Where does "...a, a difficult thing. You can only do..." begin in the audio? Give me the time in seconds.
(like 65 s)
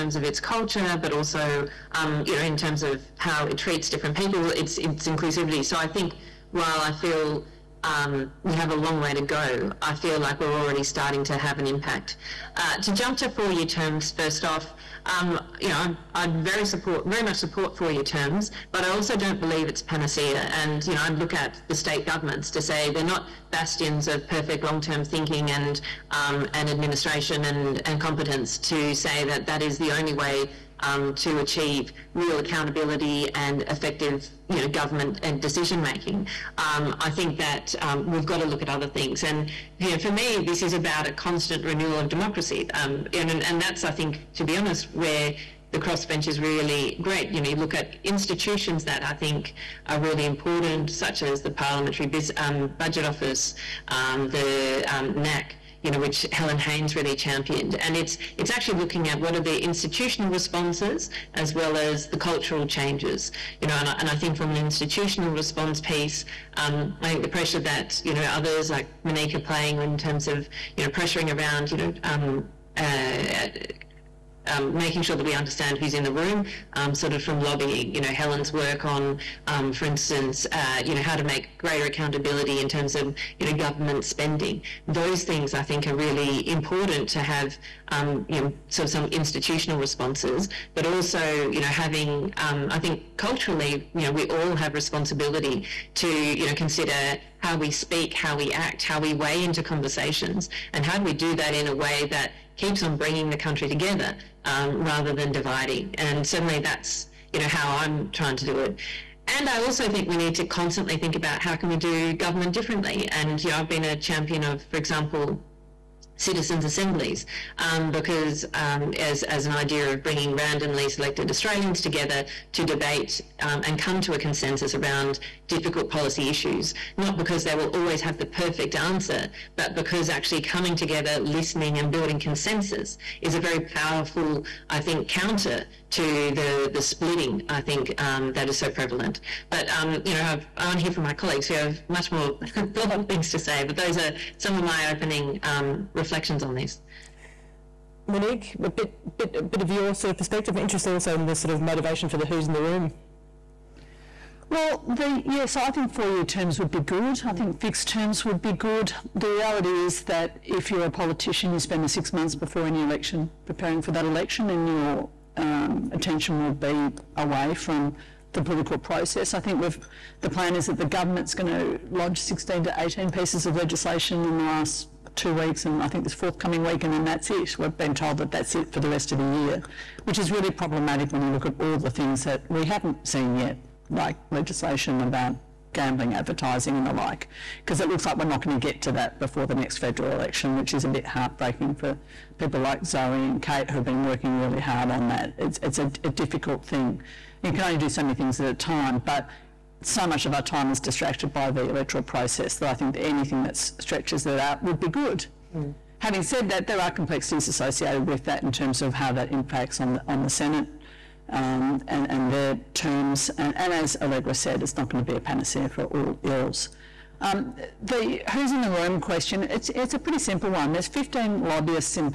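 195 s.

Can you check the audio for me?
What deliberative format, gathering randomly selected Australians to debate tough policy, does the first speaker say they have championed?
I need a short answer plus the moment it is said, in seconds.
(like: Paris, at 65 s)
Citizens' assemblies, at 116 s.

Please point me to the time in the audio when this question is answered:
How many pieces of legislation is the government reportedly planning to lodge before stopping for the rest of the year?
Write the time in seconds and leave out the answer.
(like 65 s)
172 s.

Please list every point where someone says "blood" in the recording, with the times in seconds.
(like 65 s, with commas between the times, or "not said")
not said.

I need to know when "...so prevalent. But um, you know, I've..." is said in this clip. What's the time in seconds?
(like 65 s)
138 s.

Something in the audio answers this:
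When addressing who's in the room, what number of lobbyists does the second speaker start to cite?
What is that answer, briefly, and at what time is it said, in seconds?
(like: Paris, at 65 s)
15, at 220 s.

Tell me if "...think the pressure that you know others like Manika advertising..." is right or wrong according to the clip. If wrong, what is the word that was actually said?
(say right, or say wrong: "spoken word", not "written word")
wrong: "playing", not "advertising".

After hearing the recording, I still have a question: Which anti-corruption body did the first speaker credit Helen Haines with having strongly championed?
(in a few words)
NACC.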